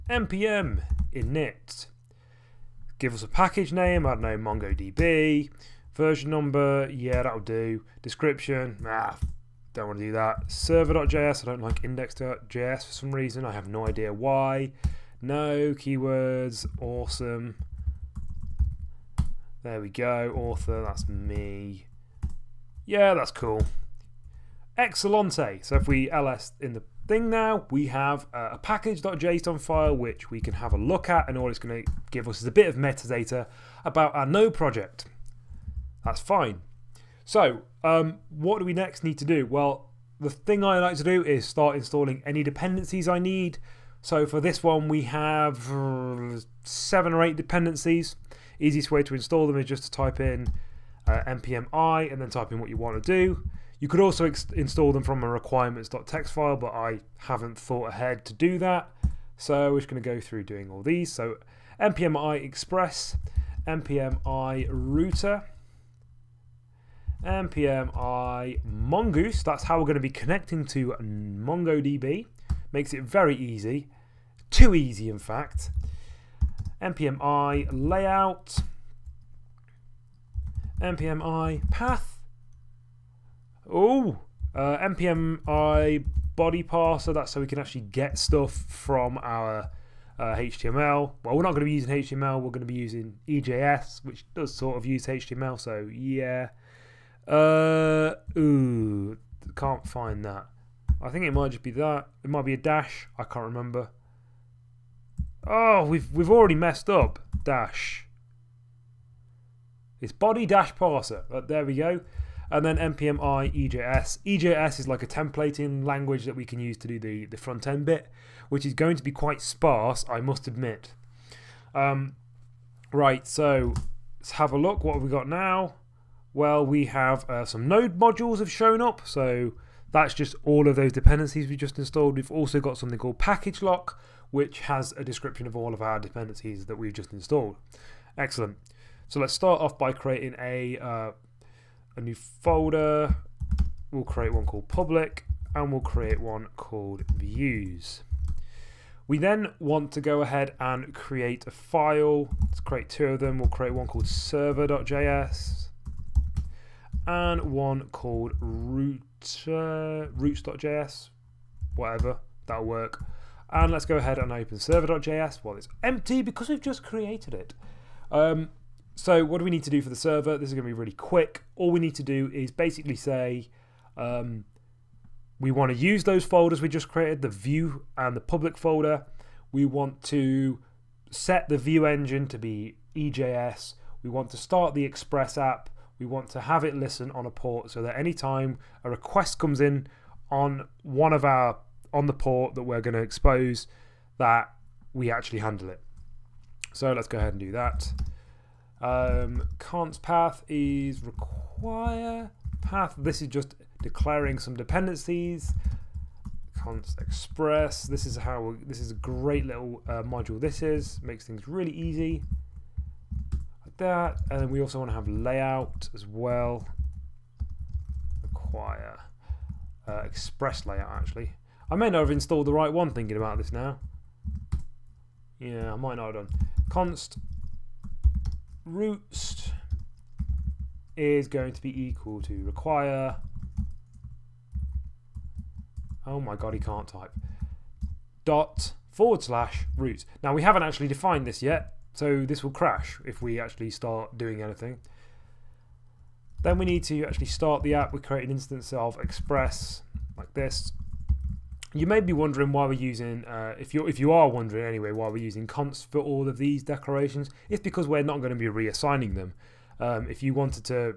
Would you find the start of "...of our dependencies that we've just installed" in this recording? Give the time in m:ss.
2:15.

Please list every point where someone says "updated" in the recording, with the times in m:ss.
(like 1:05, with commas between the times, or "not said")
not said.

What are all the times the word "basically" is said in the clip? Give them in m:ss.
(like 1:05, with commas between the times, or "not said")
2:52.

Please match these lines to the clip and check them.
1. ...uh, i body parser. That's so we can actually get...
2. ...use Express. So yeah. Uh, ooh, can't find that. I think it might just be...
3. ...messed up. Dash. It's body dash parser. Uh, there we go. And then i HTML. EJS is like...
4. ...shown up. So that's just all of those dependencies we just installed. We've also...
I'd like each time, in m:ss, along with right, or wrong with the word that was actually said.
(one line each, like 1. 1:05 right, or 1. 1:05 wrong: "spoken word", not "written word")
1. 1:24 right
2. 1:34 wrong: "HTML", not "Express"
3. 1:46 wrong: "EJS", not "HTML"
4. 2:08 right.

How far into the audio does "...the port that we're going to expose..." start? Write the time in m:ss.
3:12.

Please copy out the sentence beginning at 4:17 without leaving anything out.
It's because we're not going to be reassigning them.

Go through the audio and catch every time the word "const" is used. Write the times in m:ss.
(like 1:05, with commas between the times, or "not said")
3:19, 3:26, 3:46, 4:15.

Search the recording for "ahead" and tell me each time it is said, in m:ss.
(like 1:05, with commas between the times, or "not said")
0:57, 2:30, 2:43, 3:17.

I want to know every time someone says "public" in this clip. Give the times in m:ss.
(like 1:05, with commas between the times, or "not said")
2:24, 2:58.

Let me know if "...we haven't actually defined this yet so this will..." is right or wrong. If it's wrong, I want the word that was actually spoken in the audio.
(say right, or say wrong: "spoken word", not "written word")
right.